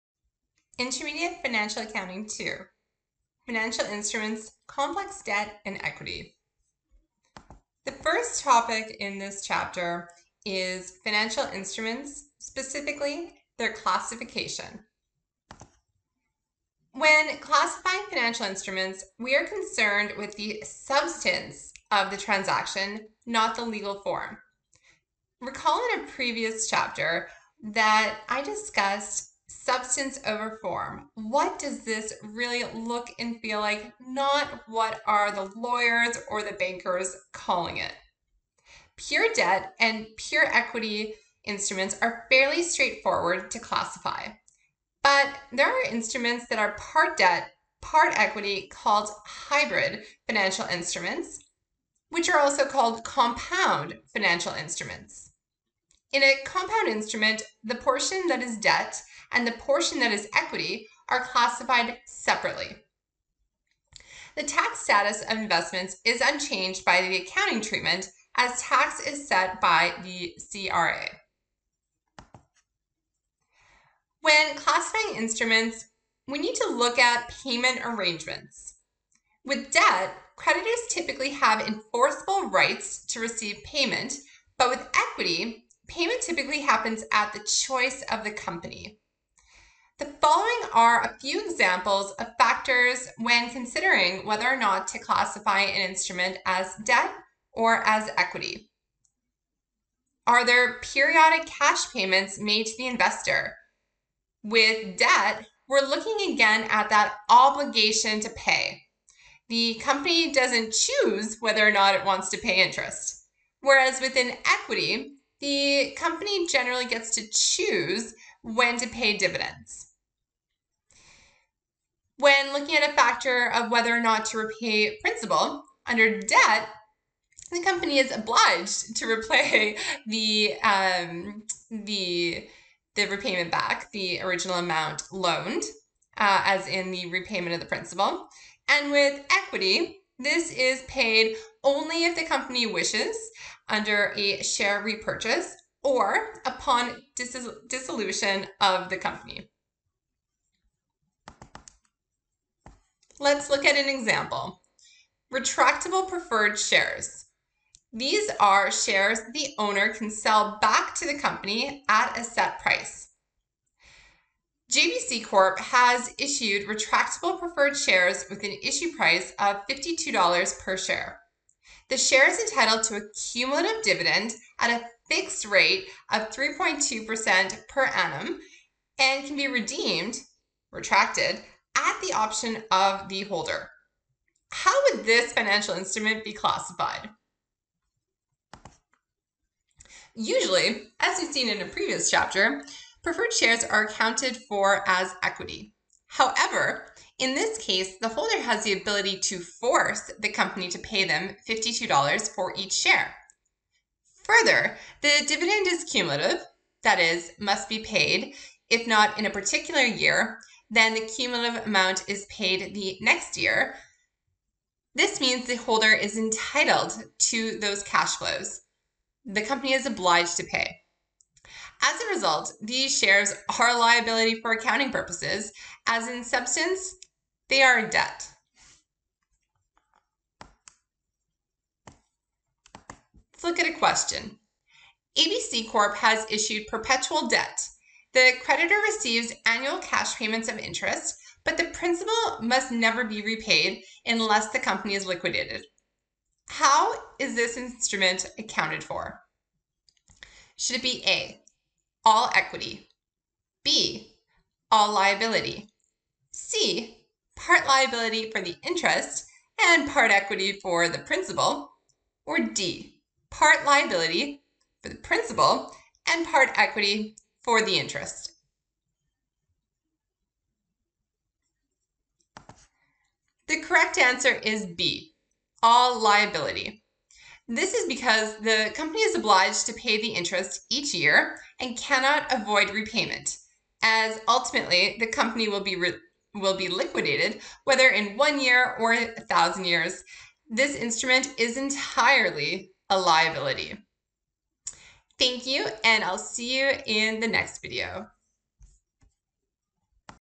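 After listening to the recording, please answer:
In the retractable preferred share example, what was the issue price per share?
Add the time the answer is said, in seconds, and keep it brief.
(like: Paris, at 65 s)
$52, at 169 s.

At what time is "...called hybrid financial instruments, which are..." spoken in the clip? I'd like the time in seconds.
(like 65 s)
48 s.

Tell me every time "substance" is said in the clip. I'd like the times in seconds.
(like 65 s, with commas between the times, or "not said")
20 s, 29 s, 226 s.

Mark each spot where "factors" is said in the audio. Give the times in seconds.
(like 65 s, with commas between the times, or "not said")
92 s, 122 s.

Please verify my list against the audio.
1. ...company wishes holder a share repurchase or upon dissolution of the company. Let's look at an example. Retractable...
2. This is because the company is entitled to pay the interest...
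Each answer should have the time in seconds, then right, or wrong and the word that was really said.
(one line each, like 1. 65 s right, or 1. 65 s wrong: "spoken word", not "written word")
1. 142 s wrong: "under", not "holder"
2. 277 s wrong: "obliged", not "entitled".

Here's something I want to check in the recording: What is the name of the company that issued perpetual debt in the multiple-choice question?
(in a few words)
ABC Corp.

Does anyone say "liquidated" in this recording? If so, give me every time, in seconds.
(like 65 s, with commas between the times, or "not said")
245 s, 286 s.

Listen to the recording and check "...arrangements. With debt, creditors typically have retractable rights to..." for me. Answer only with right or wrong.
wrong.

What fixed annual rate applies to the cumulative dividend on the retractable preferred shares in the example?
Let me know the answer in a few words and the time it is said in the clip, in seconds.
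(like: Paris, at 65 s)
3.2%, at 176 s.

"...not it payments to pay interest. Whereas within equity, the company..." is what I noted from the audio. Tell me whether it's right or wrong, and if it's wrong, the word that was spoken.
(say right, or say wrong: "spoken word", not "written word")
wrong: "wants", not "payments".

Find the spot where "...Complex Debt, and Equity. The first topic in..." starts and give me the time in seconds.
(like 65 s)
4 s.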